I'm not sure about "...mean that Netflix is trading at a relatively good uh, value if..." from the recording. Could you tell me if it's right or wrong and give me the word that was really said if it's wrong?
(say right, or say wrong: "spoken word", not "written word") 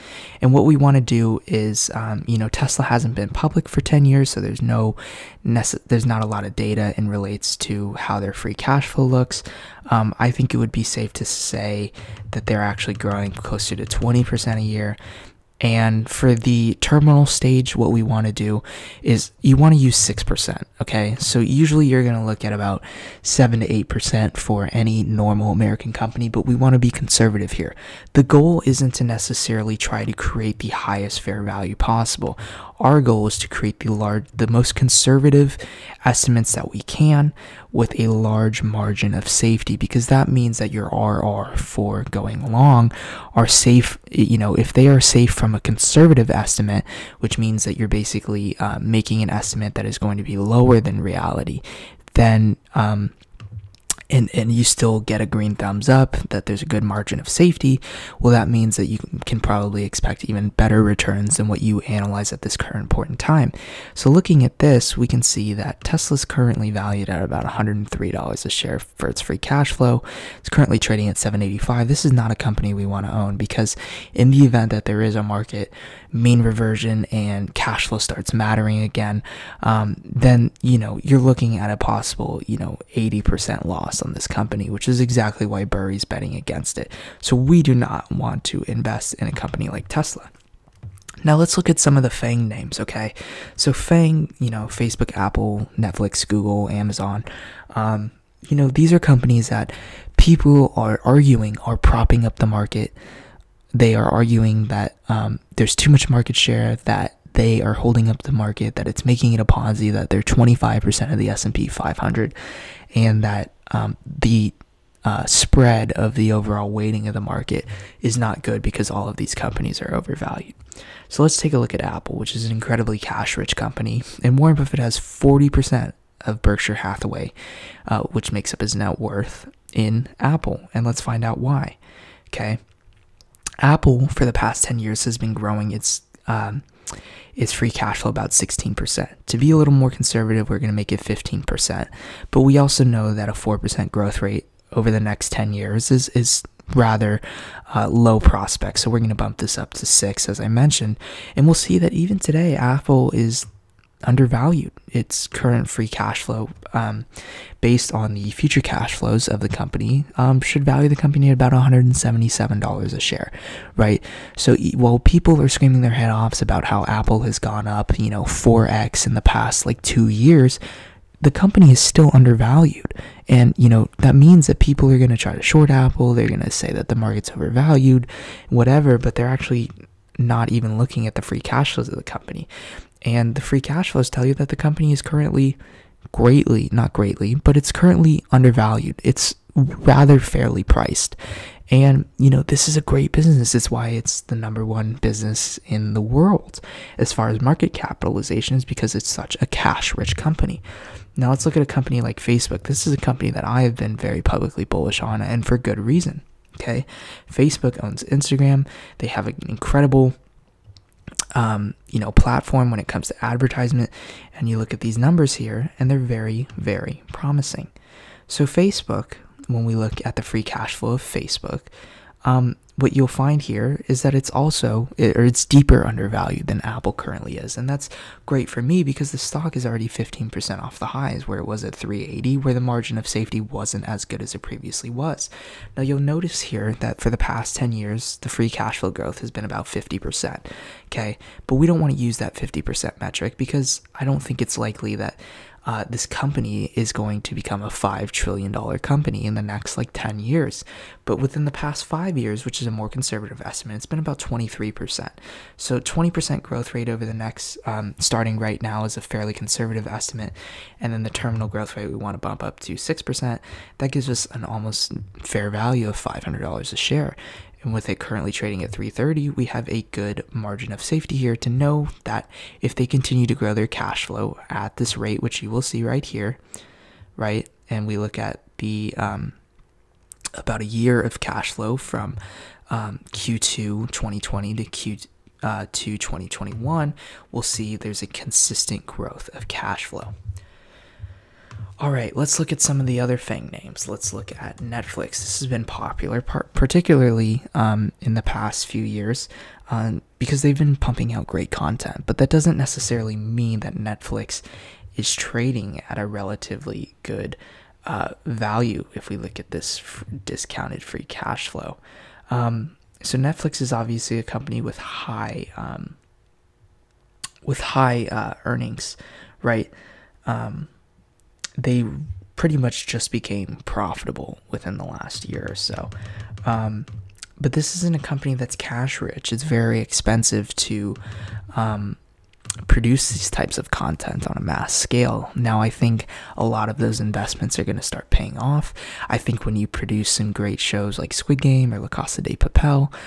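right.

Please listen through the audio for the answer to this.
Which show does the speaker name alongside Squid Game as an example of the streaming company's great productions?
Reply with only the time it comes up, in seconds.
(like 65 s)
341 s.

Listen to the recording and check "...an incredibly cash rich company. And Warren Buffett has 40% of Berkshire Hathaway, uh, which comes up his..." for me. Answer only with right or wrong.
wrong.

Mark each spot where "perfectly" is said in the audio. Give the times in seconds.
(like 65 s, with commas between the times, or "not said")
not said.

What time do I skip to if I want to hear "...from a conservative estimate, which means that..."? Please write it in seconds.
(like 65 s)
45 s.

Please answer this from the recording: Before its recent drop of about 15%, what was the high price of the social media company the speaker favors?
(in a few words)
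380.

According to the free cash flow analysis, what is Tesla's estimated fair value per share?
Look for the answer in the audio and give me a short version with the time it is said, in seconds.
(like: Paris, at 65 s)
$103, at 67 s.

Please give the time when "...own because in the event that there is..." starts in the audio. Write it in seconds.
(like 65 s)
73 s.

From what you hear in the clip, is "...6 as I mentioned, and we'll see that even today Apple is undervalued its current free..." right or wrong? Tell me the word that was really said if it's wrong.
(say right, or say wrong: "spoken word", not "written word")
right.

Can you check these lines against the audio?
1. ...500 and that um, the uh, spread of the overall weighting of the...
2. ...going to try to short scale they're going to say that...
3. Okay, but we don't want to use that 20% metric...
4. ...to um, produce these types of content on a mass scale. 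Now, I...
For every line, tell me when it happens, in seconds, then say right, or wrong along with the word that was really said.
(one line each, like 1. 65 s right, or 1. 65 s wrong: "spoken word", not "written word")
1. 111 s right
2. 174 s wrong: "apple", not "scale"
3. 240 s wrong: "50", not "20"
4. 330 s right.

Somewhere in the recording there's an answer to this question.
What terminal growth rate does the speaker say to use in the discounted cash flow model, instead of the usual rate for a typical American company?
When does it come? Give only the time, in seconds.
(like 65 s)
19 s.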